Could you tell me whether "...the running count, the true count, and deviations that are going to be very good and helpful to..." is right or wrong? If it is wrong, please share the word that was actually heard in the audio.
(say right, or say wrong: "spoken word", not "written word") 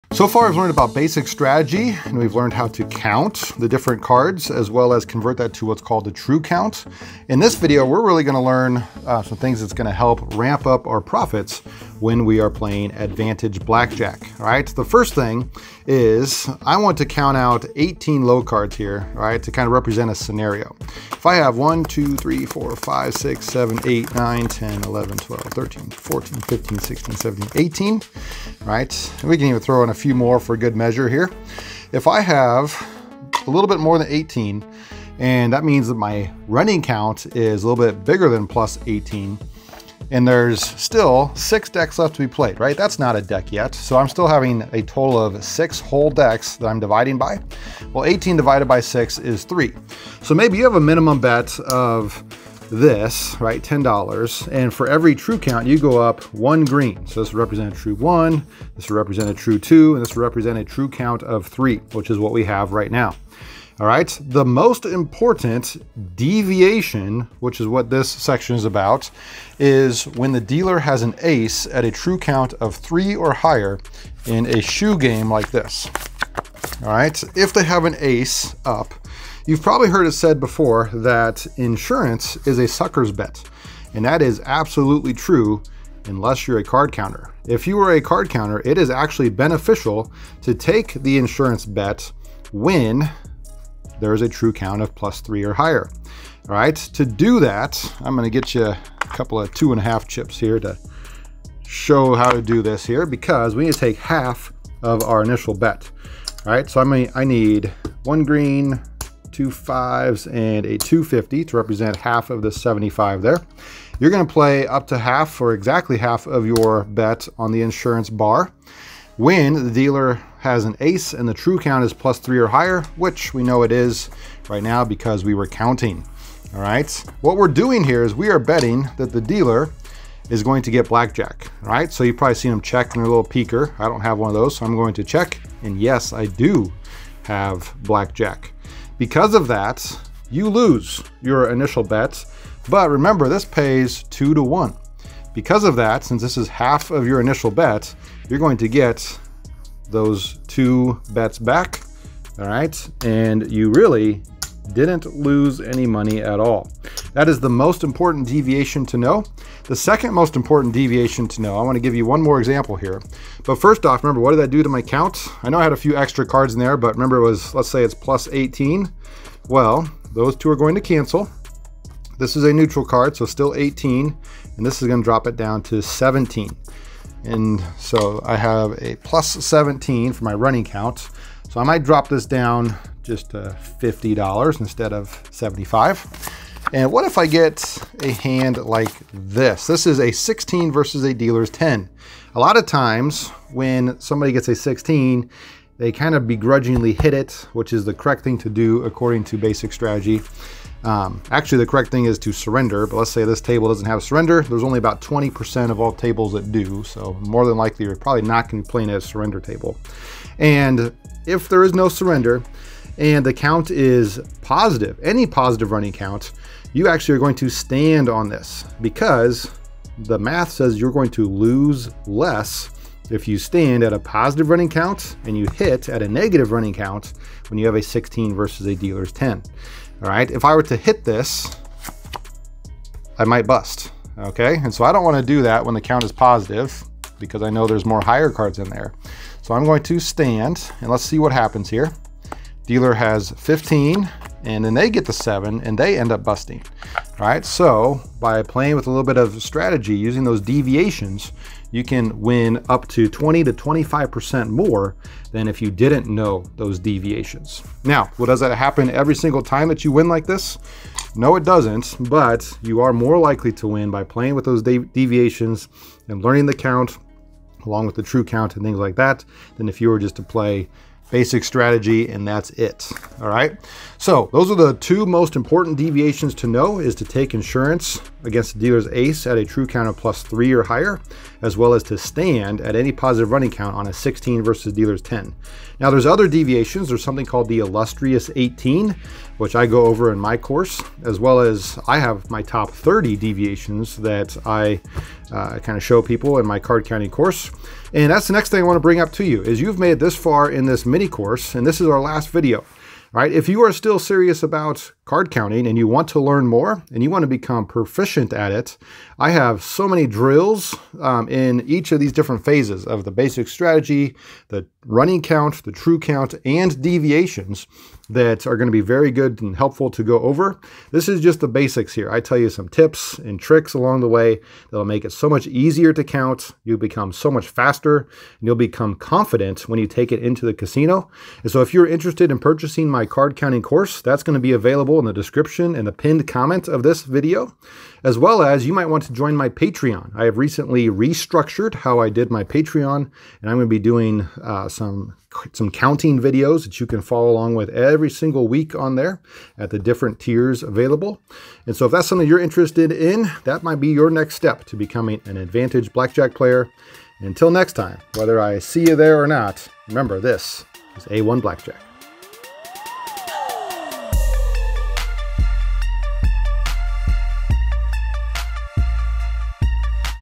right.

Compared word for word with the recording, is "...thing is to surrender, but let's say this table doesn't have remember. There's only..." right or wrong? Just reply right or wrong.
wrong.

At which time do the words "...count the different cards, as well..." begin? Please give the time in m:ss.
0:02.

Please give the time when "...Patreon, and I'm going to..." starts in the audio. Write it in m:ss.
5:42.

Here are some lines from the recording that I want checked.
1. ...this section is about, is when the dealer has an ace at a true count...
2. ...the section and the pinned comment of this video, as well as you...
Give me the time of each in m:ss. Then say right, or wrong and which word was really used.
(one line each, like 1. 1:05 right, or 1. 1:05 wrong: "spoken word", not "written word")
1. 1:07 right
2. 5:35 wrong: "description", not "section".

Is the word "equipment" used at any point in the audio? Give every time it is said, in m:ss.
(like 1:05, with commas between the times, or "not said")
not said.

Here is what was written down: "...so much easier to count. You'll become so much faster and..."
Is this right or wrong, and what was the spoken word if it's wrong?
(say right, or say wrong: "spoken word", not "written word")
right.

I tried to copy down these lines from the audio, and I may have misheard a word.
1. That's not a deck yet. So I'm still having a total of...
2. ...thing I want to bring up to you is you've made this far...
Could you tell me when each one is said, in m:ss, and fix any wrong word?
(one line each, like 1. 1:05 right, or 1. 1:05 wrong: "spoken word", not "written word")
1. 0:42 right
2. 4:58 right.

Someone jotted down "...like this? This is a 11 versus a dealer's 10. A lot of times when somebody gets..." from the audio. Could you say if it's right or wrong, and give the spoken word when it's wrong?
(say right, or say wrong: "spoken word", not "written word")
wrong: "16", not "11".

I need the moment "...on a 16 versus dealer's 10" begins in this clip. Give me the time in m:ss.
4:43.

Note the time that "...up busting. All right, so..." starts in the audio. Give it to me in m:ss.
4:06.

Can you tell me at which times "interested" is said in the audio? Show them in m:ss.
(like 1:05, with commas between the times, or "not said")
5:31, 5:52.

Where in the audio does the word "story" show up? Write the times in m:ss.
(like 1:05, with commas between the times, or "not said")
not said.